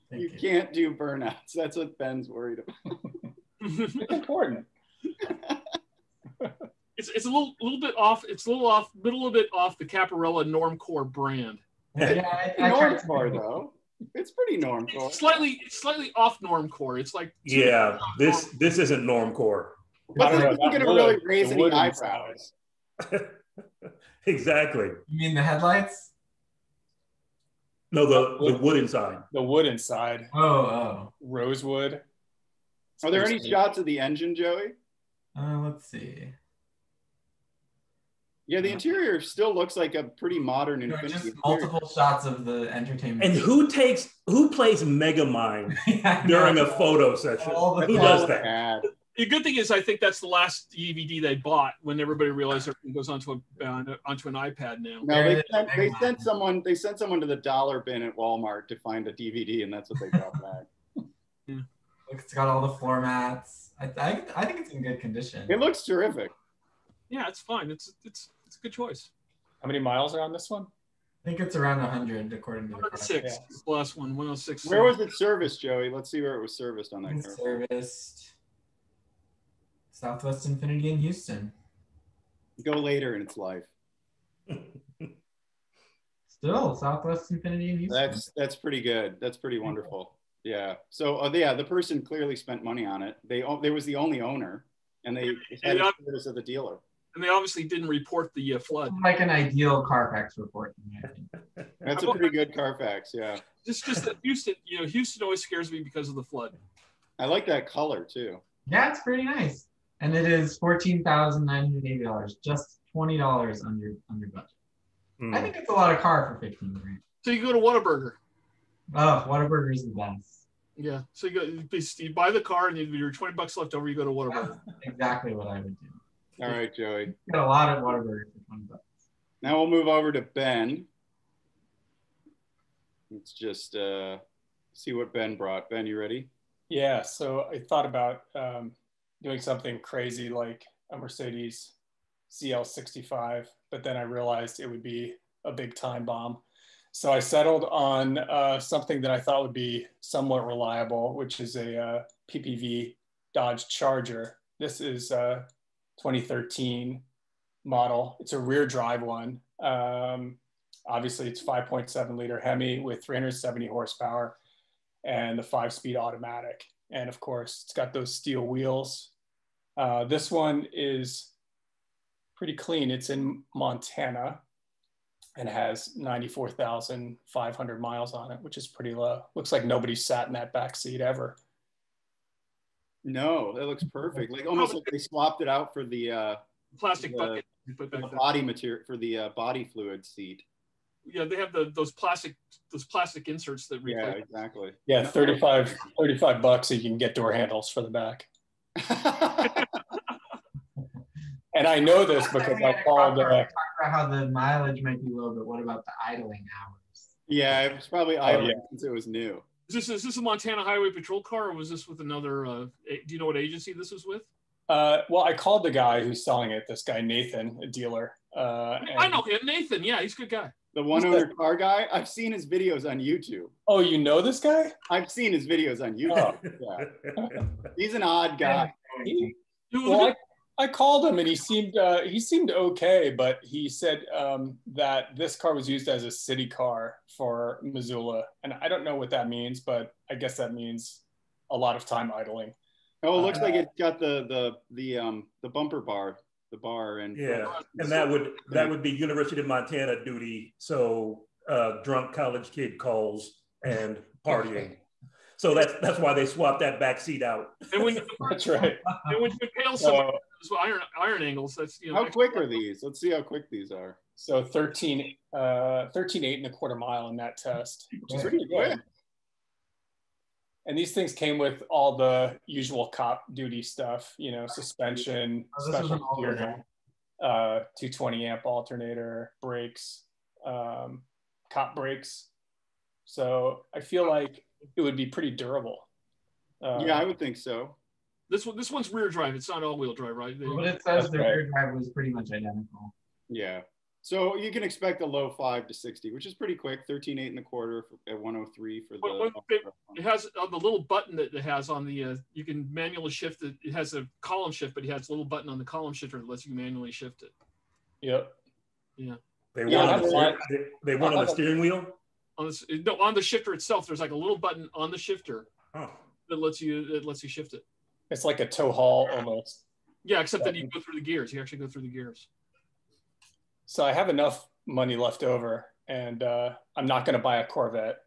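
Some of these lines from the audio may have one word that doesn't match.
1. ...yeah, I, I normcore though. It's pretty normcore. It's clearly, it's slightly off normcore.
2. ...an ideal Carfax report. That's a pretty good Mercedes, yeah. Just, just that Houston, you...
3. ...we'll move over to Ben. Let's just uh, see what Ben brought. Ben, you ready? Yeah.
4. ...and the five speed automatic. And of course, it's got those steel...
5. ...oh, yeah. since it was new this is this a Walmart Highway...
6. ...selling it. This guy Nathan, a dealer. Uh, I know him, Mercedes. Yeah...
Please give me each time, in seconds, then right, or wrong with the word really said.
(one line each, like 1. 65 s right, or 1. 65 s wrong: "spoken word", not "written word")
1. 11 s wrong: "slightly", not "clearly"
2. 99 s wrong: "Carfax", not "Mercedes"
3. 129 s right
4. 165 s right
5. 208 s wrong: "Montana", not "Walmart"
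6. 216 s wrong: "Nathan", not "Mercedes".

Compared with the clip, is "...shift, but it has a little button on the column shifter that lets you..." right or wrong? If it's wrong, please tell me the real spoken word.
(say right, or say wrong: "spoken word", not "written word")
right.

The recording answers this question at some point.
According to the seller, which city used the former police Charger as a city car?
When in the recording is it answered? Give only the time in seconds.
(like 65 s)
237 s.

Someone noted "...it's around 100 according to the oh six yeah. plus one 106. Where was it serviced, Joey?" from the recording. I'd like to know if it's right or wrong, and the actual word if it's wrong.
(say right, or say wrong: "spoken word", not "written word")
right.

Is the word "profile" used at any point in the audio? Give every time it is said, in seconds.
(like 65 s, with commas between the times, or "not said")
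not said.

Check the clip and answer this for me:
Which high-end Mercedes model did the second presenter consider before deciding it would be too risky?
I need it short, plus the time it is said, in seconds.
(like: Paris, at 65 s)
Mercedes CL65, at 140 s.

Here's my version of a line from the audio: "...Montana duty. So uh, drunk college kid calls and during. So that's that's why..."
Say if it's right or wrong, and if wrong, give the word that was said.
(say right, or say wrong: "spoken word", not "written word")
wrong: "partying", not "during".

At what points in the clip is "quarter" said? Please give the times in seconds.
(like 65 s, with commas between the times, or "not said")
266 s, 297 s.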